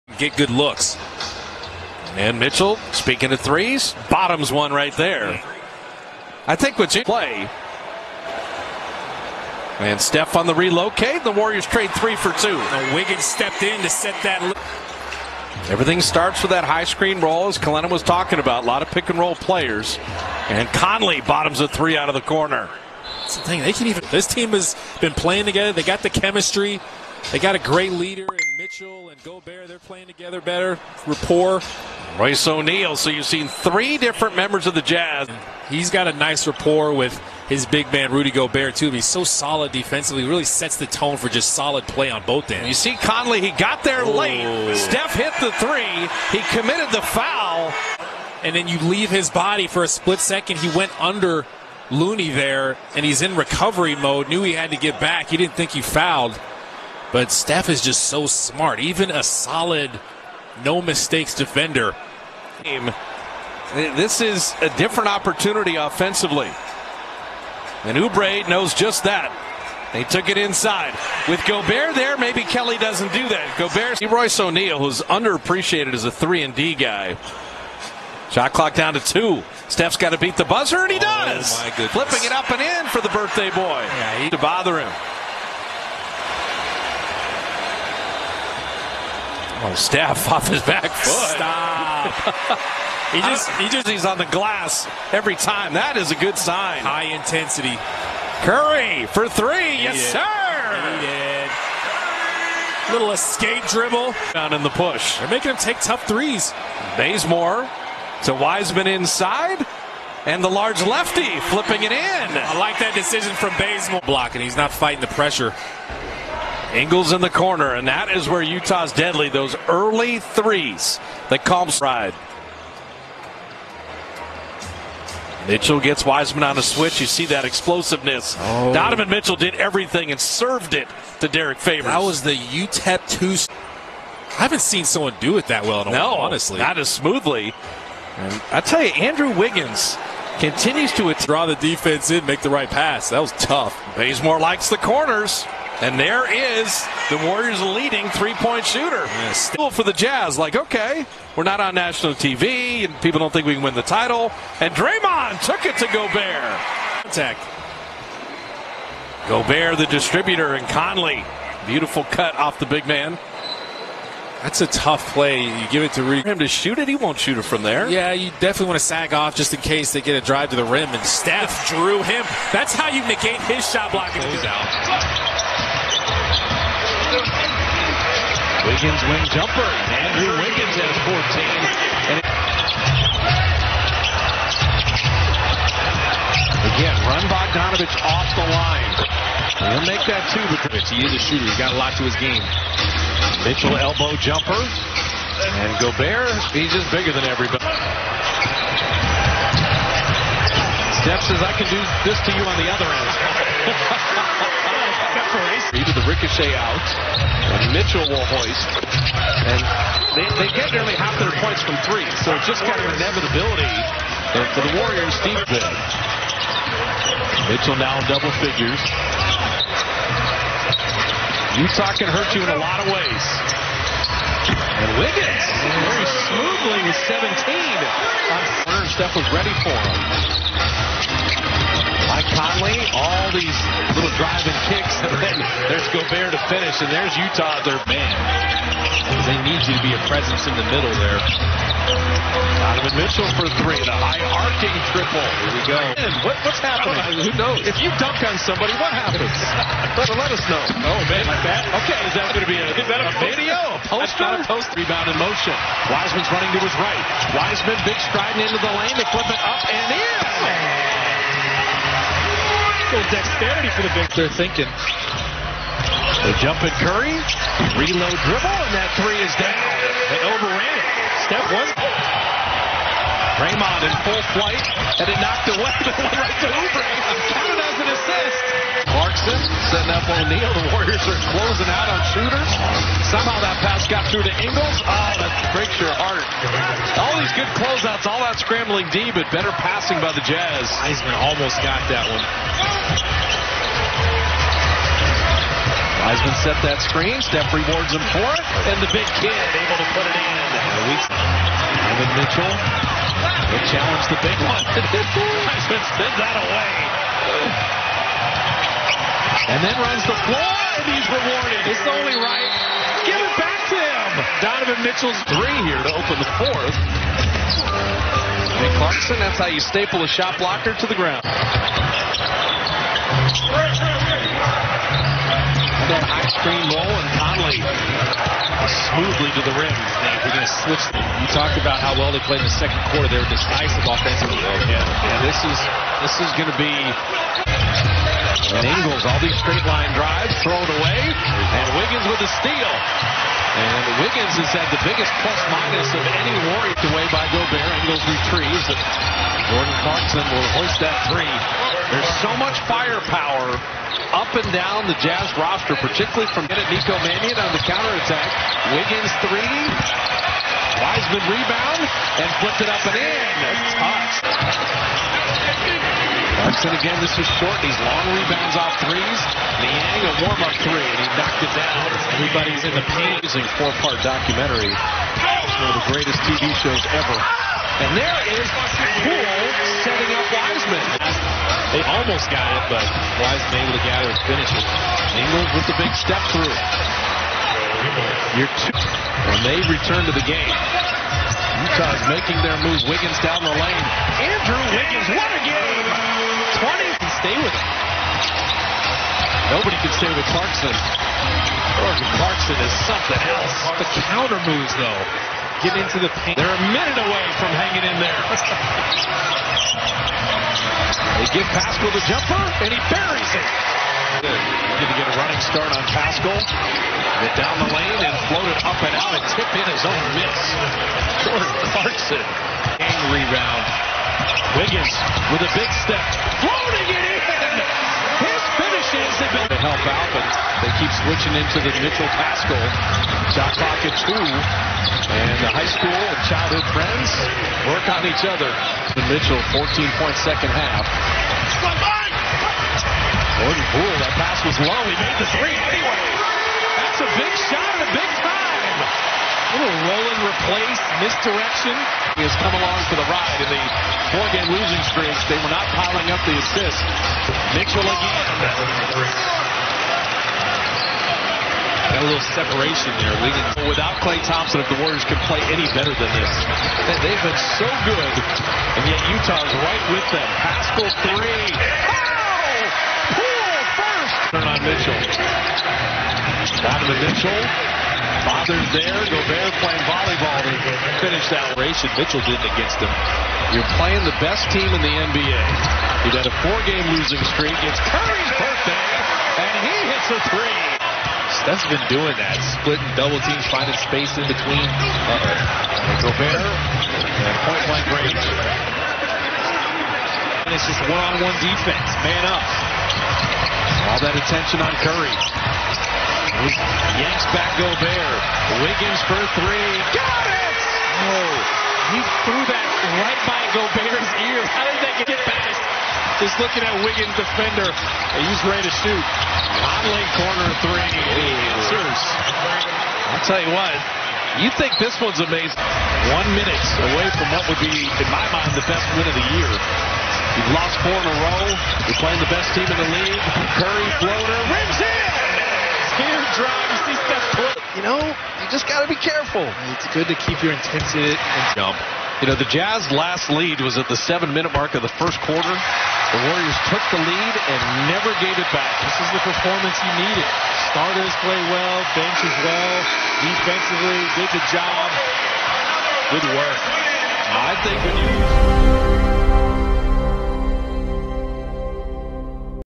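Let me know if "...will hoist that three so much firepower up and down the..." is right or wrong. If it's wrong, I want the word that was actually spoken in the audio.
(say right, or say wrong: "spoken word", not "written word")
right.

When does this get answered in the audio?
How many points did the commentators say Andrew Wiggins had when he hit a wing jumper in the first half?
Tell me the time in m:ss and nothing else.
3:01.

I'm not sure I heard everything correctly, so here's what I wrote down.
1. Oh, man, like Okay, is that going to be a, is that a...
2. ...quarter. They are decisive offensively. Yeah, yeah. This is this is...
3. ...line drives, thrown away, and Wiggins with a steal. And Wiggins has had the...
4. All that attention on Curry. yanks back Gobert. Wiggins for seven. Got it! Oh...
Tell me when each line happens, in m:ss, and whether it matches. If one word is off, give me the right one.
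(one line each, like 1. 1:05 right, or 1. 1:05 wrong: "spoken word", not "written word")
1. 4:10 right
2. 5:32 right
3. 5:39 right
4. 8:23 wrong: "three", not "seven".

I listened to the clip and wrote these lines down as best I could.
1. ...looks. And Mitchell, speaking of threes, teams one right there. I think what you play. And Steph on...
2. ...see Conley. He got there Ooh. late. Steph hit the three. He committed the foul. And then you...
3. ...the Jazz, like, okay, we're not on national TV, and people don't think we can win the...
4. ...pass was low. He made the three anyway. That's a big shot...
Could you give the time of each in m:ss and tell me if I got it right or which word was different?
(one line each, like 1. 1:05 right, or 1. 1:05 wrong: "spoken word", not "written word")
1. 0:00 wrong: "bottoms", not "teams"
2. 0:42 right
3. 2:29 right
4. 7:24 right.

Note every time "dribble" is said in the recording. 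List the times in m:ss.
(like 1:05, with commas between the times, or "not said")
1:43, 4:28.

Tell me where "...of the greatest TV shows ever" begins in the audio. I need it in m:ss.
6:15.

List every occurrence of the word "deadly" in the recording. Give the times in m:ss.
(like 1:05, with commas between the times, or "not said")
1:58.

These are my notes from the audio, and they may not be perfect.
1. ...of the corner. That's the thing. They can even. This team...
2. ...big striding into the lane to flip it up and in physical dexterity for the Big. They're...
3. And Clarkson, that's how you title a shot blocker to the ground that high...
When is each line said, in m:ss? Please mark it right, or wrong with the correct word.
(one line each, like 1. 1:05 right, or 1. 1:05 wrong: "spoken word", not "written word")
1. 0:22 right
2. 4:17 right
3. 5:18 wrong: "staple", not "title".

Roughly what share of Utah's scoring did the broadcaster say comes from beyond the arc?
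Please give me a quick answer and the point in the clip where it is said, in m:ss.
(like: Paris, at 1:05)
nearly half, at 3:30.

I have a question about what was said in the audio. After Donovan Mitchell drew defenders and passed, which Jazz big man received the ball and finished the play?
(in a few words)
Derrick Favors.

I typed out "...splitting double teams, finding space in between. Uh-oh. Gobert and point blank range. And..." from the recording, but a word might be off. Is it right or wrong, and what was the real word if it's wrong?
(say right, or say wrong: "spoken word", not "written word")
right.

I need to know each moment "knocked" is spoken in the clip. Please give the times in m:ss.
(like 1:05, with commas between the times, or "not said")
4:35, 6:11.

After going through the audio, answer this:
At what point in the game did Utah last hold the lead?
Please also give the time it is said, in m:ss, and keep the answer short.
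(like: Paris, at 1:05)
7-minute mark, first quarter, at 9:03.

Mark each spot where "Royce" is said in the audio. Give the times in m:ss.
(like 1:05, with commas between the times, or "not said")
0:32, 1:14.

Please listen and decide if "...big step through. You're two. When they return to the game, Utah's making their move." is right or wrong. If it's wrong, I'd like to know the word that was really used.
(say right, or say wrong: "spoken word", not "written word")
right.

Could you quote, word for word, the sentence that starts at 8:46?
One minute away from what would be, in my mind, the best win of the year.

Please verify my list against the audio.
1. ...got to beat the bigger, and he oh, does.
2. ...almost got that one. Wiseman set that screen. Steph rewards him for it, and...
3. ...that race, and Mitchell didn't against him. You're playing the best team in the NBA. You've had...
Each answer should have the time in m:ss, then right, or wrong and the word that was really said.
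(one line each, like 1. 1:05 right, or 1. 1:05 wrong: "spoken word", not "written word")
1. 1:19 wrong: "buzzer", not "bigger"
2. 4:51 right
3. 8:01 right.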